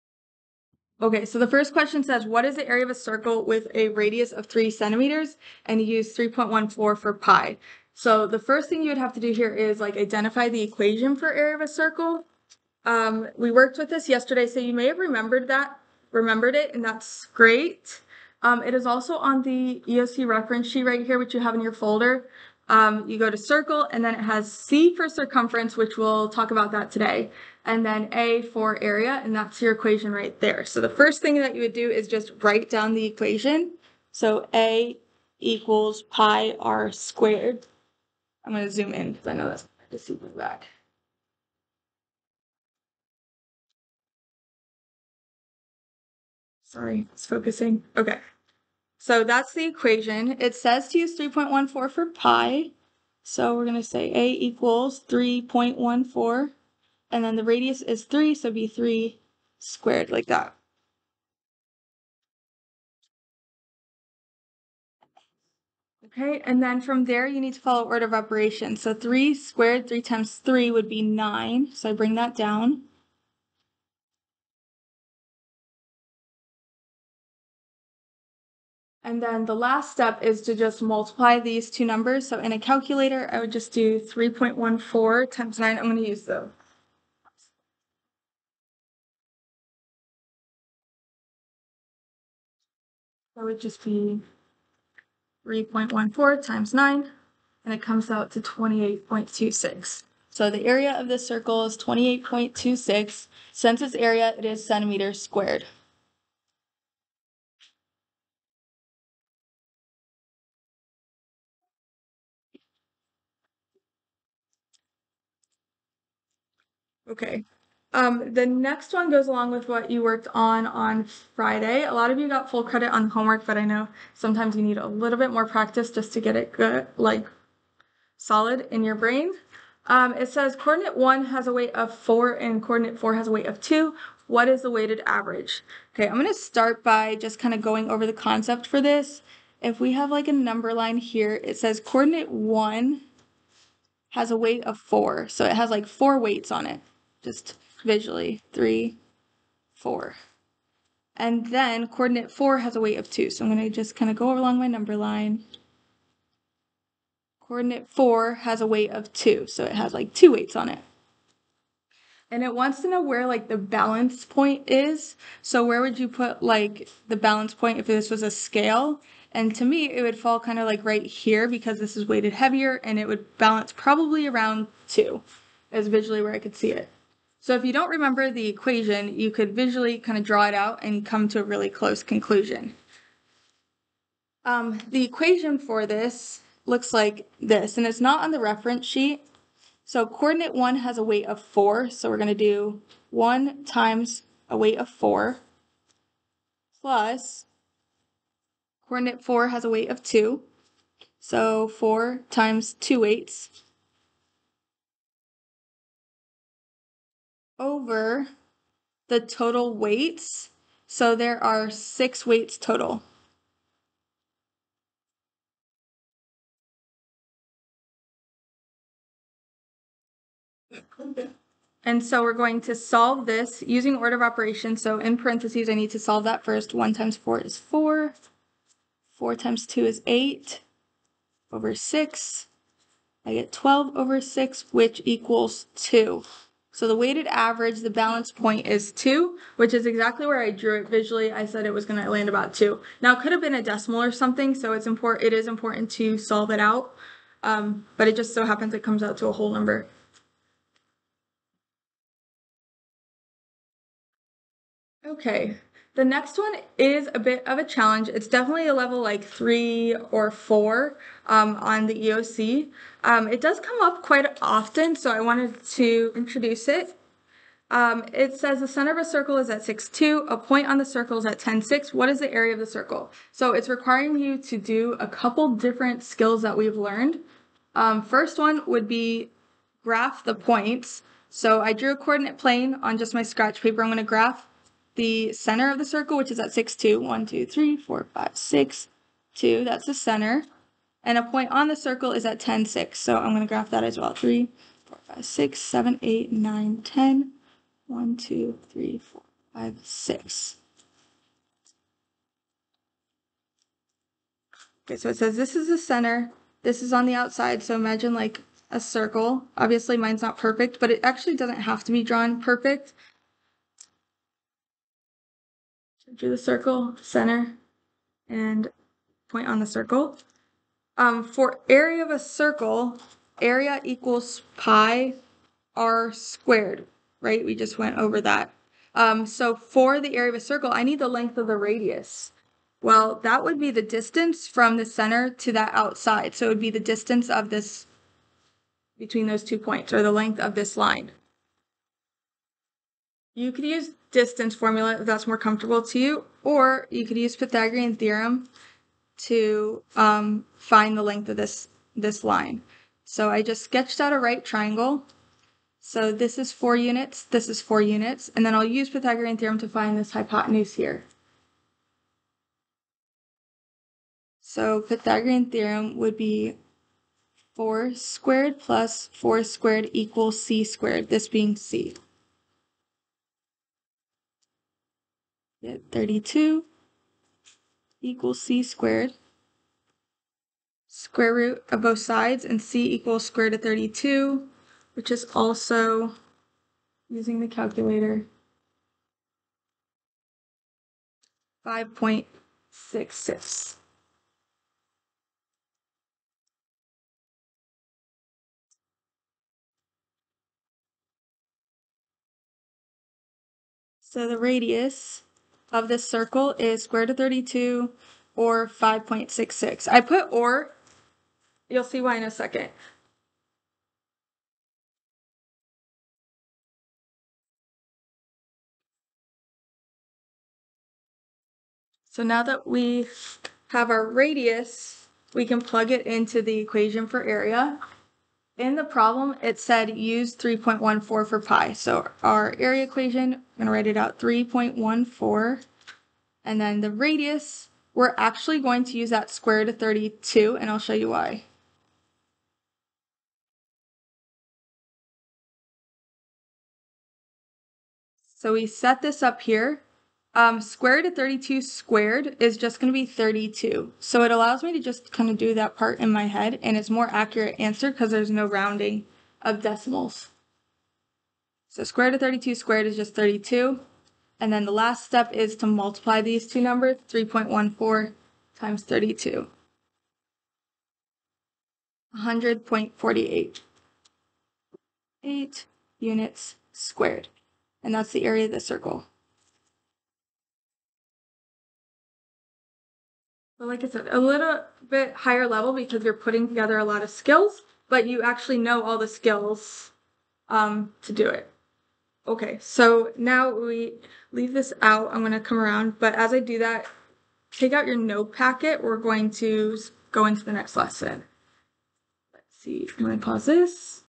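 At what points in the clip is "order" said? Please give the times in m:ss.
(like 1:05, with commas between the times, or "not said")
1:07, 3:43.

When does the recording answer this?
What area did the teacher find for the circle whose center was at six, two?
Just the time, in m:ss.
7:52.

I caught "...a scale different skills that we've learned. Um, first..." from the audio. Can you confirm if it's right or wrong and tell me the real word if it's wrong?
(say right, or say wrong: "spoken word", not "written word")
wrong: "couple", not "scale".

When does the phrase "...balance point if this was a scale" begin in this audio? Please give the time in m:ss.
2:47.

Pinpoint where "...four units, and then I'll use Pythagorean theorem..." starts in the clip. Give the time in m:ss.
5:57.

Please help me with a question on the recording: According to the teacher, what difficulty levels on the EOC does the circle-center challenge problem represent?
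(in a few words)
3 or 4.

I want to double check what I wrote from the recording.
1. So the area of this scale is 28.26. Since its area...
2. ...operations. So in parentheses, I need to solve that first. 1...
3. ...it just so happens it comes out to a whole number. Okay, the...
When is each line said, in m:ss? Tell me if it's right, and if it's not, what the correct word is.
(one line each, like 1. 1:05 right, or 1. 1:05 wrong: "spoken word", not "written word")
1. 1:40 wrong: "circle", not "scale"
2. 3:44 right
3. 4:08 right.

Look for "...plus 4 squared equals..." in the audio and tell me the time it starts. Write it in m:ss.
6:08.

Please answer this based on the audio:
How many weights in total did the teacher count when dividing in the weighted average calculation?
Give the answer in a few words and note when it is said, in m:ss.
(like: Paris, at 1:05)
6, at 3:31.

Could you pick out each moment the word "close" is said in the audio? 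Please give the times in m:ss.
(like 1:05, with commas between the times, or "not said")
3:01.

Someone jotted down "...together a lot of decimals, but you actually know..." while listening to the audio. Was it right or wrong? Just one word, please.
wrong.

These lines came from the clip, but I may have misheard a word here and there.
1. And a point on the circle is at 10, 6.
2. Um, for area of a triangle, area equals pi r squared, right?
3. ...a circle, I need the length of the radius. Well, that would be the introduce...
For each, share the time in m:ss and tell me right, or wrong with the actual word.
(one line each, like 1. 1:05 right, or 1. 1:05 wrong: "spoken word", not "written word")
1. 4:51 right
2. 5:20 wrong: "circle", not "triangle"
3. 5:30 wrong: "distance", not "introduce".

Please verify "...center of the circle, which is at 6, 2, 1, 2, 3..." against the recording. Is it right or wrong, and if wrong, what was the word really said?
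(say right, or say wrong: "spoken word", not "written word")
right.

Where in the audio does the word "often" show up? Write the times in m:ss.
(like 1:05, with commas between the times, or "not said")
4:24.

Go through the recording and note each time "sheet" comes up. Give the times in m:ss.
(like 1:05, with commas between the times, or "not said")
0:20, 3:08.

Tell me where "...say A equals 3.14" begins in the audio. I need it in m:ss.
0:53.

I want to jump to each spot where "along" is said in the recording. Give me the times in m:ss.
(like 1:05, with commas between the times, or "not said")
1:59, 2:34.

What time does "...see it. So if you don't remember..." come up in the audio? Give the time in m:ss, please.
2:56.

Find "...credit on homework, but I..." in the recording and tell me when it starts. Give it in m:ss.
2:02.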